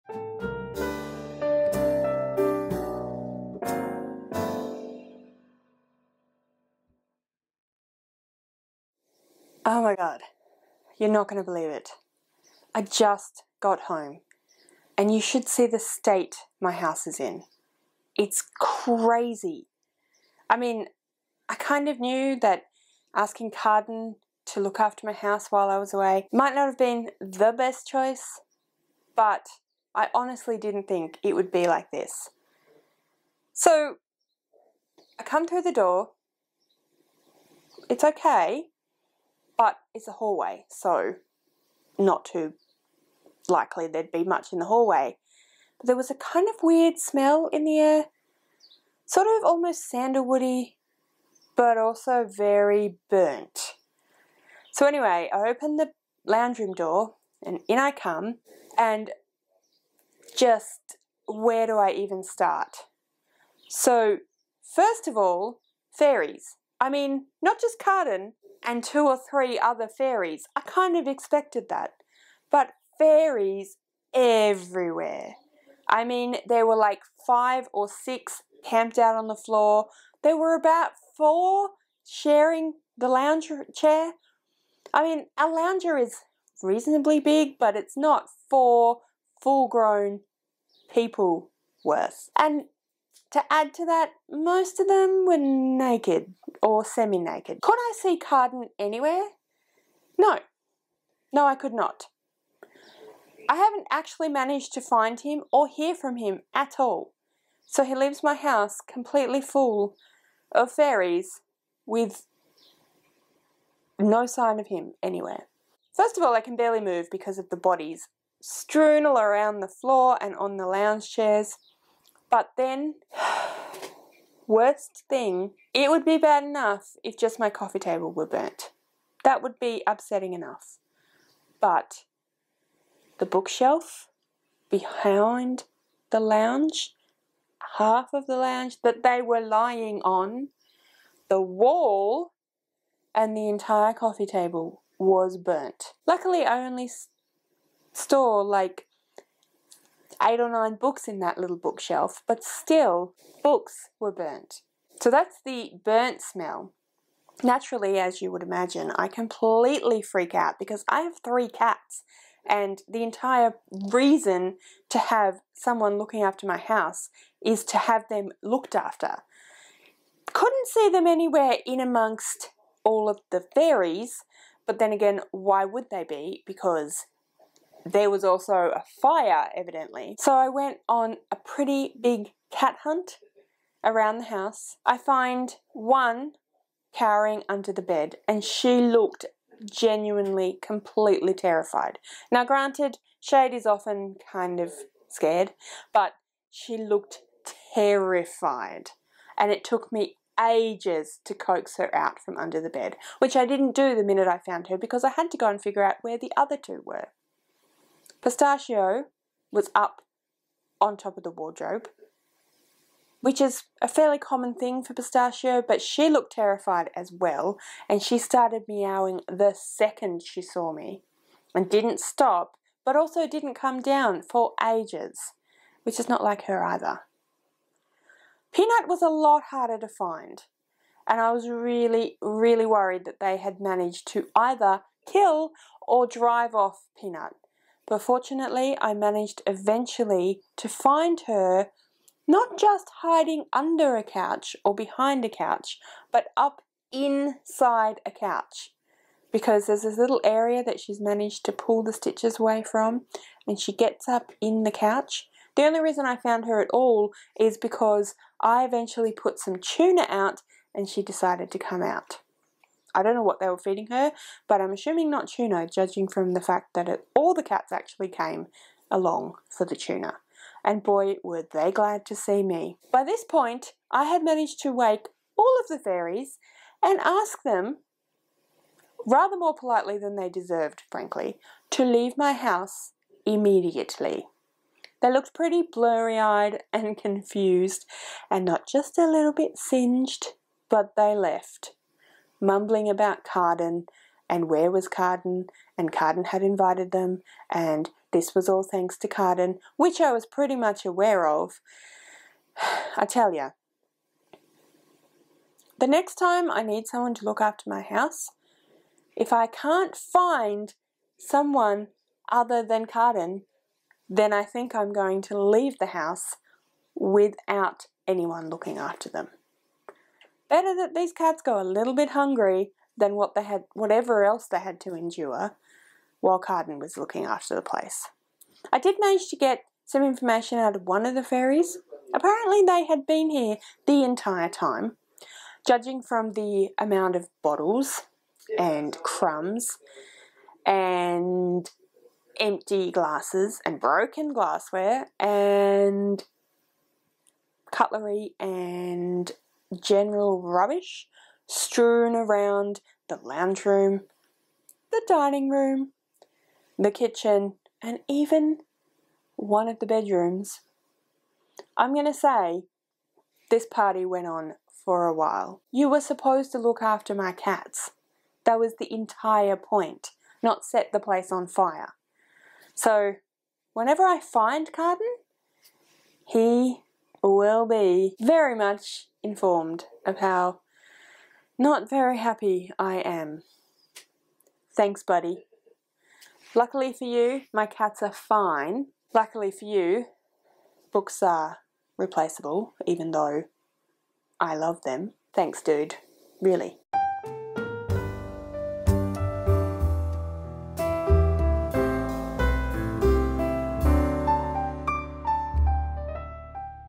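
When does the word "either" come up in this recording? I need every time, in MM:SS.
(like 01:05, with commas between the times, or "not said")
03:46, 03:54.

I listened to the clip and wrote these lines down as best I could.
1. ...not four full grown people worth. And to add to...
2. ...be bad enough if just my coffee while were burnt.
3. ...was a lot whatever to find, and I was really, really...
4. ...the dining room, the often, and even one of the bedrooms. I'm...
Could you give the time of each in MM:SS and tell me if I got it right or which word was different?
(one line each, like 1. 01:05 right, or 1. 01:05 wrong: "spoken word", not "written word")
1. 01:27 right
2. 02:06 wrong: "table", not "while"
3. 03:48 wrong: "harder", not "whatever"
4. 05:54 wrong: "kitchen", not "often".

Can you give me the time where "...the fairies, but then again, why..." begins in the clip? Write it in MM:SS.
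02:53.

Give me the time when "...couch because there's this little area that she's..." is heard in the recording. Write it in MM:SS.
04:08.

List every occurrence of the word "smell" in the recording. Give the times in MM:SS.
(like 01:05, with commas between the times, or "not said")
00:46, 02:36.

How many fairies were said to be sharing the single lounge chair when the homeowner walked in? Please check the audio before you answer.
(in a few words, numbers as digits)
4.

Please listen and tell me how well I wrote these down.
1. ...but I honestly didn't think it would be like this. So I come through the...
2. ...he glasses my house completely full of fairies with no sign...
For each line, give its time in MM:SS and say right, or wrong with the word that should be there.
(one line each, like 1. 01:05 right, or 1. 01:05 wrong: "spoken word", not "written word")
1. 00:29 right
2. 01:47 wrong: "leaves", not "glasses".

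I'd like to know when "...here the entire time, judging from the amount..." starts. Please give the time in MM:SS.
05:33.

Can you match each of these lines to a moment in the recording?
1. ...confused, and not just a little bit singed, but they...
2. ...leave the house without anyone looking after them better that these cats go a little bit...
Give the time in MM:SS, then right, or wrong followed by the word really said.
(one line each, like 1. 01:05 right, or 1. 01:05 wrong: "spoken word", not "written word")
1. 04:46 right
2. 05:15 right.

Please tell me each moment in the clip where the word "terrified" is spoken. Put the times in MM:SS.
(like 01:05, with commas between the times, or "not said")
03:11, 03:17, 03:36.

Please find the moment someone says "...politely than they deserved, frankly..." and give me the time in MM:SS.
04:39.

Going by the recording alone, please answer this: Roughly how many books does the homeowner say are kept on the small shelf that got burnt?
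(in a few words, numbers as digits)
8 or 9.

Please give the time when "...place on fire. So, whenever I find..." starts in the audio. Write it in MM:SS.
06:10.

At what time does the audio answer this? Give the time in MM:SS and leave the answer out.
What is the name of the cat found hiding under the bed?
03:13.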